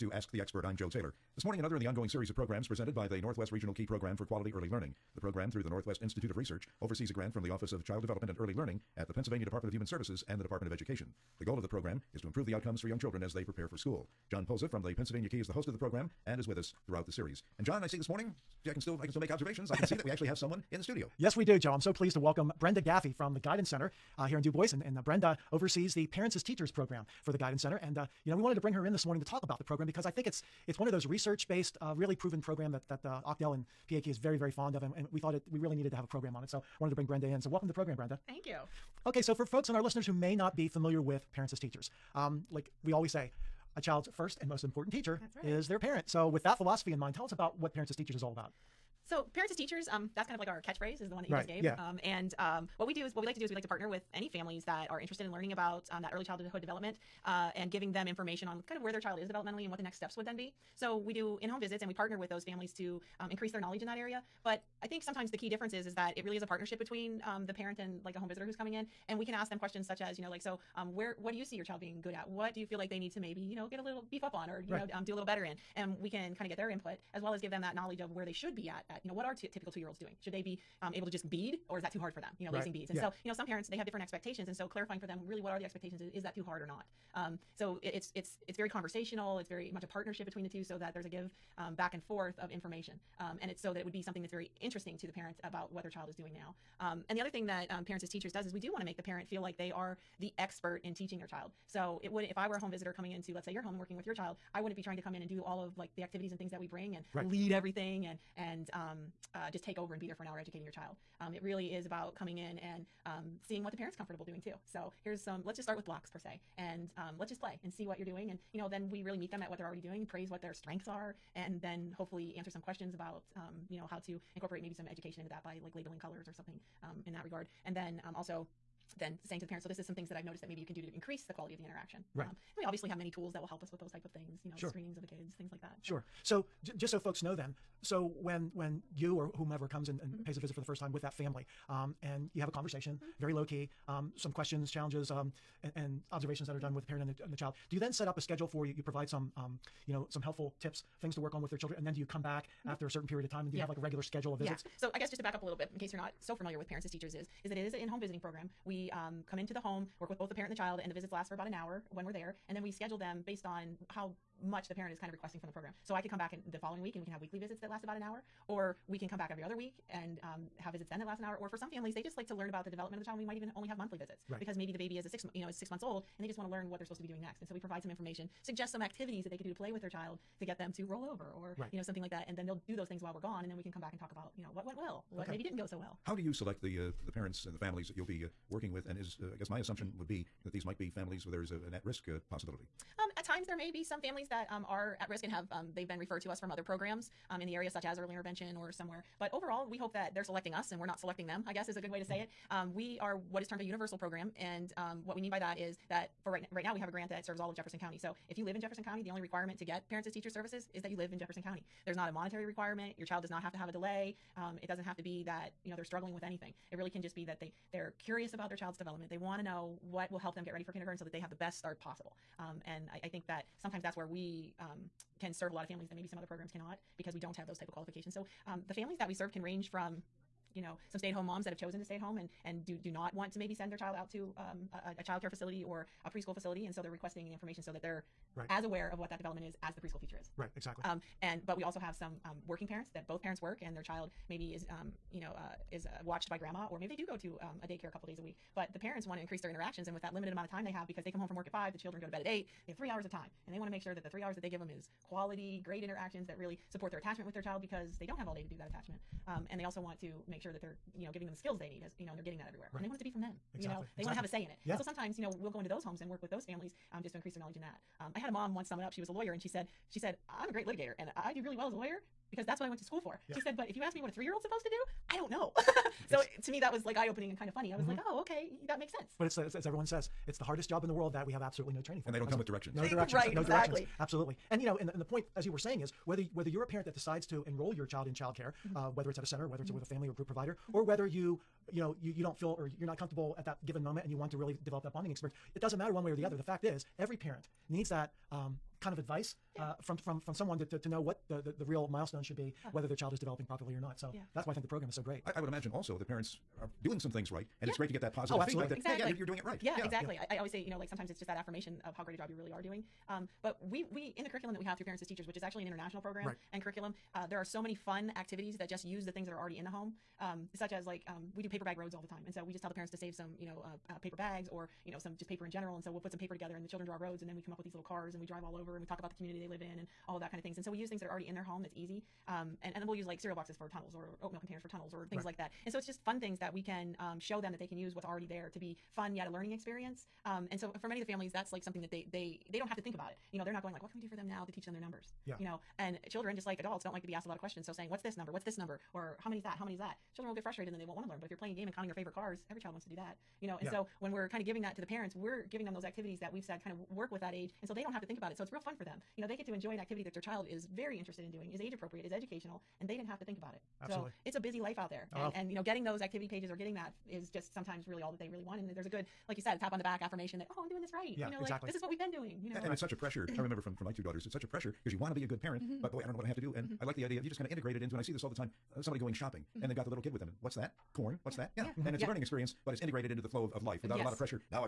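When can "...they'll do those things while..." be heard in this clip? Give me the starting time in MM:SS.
03:02.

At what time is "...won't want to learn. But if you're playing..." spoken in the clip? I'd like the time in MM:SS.
05:50.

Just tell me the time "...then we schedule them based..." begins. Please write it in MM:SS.
02:42.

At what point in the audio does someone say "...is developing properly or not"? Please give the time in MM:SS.
05:03.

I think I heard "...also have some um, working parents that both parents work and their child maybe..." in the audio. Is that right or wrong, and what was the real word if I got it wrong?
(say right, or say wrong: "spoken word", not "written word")
right.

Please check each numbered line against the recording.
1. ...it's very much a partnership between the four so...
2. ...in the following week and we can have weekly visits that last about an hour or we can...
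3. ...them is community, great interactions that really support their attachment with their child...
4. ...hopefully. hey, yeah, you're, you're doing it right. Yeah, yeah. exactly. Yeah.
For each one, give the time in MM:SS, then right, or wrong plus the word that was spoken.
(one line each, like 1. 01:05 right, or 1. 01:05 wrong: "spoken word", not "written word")
1. 01:29 wrong: "two", not "four"
2. 02:46 right
3. 04:14 wrong: "quality", not "community"
4. 05:08 wrong: "exactly", not "hopefully".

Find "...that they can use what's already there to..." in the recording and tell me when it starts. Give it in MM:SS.
05:37.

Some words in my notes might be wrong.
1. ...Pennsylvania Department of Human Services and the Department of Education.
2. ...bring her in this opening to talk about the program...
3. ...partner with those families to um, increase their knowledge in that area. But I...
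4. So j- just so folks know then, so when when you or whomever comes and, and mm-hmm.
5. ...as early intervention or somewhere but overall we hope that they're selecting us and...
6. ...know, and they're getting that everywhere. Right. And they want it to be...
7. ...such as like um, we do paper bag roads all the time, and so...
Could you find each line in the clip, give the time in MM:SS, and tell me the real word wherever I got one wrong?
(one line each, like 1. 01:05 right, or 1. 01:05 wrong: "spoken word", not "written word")
1. 00:09 right
2. 00:28 wrong: "morning", not "opening"
3. 01:01 right
4. 02:16 right
5. 03:17 right
6. 04:22 right
7. 05:20 right.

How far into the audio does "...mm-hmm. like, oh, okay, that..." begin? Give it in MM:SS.
04:37.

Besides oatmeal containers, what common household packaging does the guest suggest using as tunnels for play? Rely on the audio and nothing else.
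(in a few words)
cereal boxes.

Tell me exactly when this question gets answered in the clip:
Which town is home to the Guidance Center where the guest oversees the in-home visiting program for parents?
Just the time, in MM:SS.
00:24.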